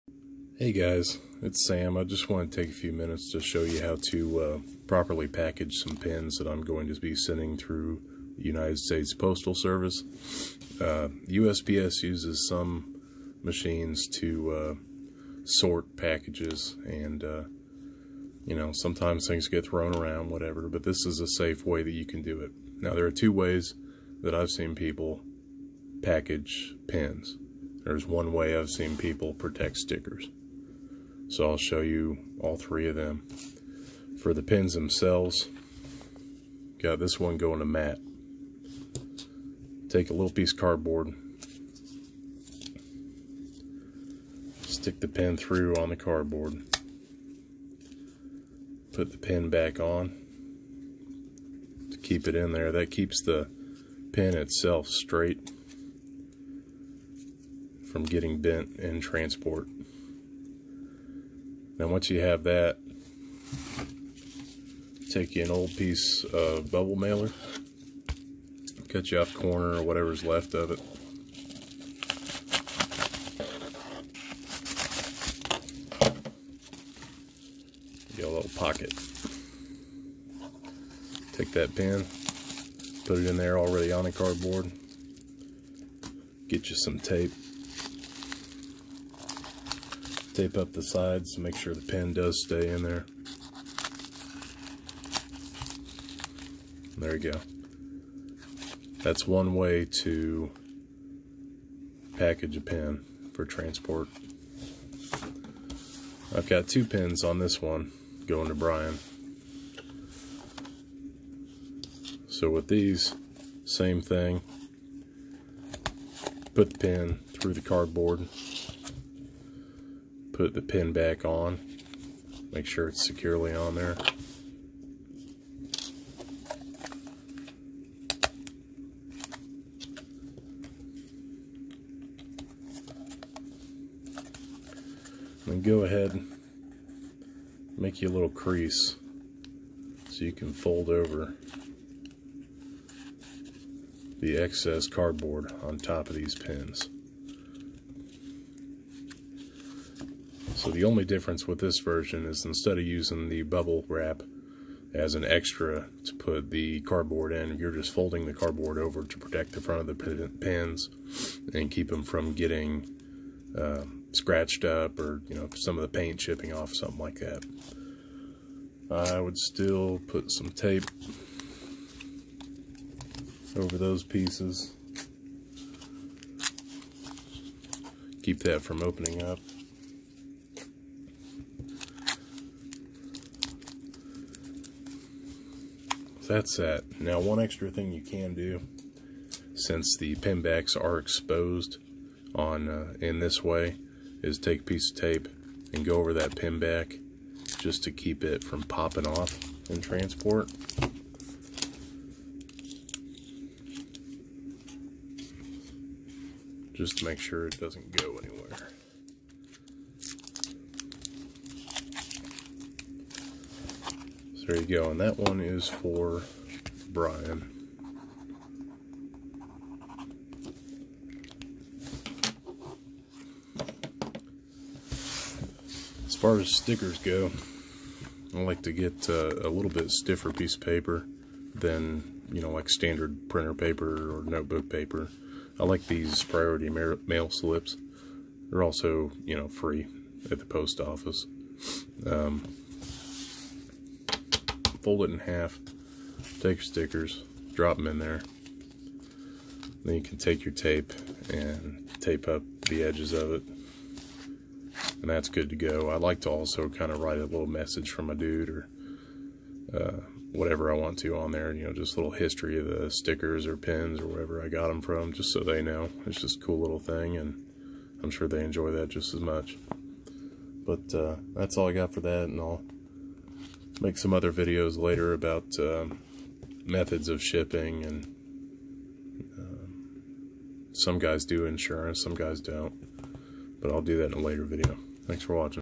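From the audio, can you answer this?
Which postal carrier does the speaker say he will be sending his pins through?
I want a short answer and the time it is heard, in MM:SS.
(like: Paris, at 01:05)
United States Postal Service, at 00:08.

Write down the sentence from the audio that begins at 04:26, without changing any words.
It's just a cool little thing, and I'm sure they enjoy that just as much.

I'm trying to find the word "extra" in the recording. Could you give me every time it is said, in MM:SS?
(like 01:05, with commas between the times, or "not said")
02:35, 03:07.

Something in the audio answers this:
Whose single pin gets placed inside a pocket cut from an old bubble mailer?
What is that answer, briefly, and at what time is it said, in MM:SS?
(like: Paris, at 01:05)
Matt, at 00:37.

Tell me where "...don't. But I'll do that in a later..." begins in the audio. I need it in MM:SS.
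04:42.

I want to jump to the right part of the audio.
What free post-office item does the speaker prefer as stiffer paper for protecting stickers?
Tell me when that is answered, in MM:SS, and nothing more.
03:56.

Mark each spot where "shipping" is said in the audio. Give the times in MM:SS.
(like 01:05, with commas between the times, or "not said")
04:37.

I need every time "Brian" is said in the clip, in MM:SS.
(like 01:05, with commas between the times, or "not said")
01:48, 03:36.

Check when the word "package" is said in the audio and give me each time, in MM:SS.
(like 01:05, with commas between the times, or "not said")
00:05, 00:15, 00:26, 01:42.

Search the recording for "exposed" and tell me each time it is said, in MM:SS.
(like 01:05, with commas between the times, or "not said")
03:10.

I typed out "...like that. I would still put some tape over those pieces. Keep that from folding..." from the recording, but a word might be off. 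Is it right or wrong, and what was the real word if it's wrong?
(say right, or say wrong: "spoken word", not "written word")
wrong: "opening", not "folding".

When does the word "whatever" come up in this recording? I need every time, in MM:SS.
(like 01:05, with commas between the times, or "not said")
00:20, 01:09, 04:20.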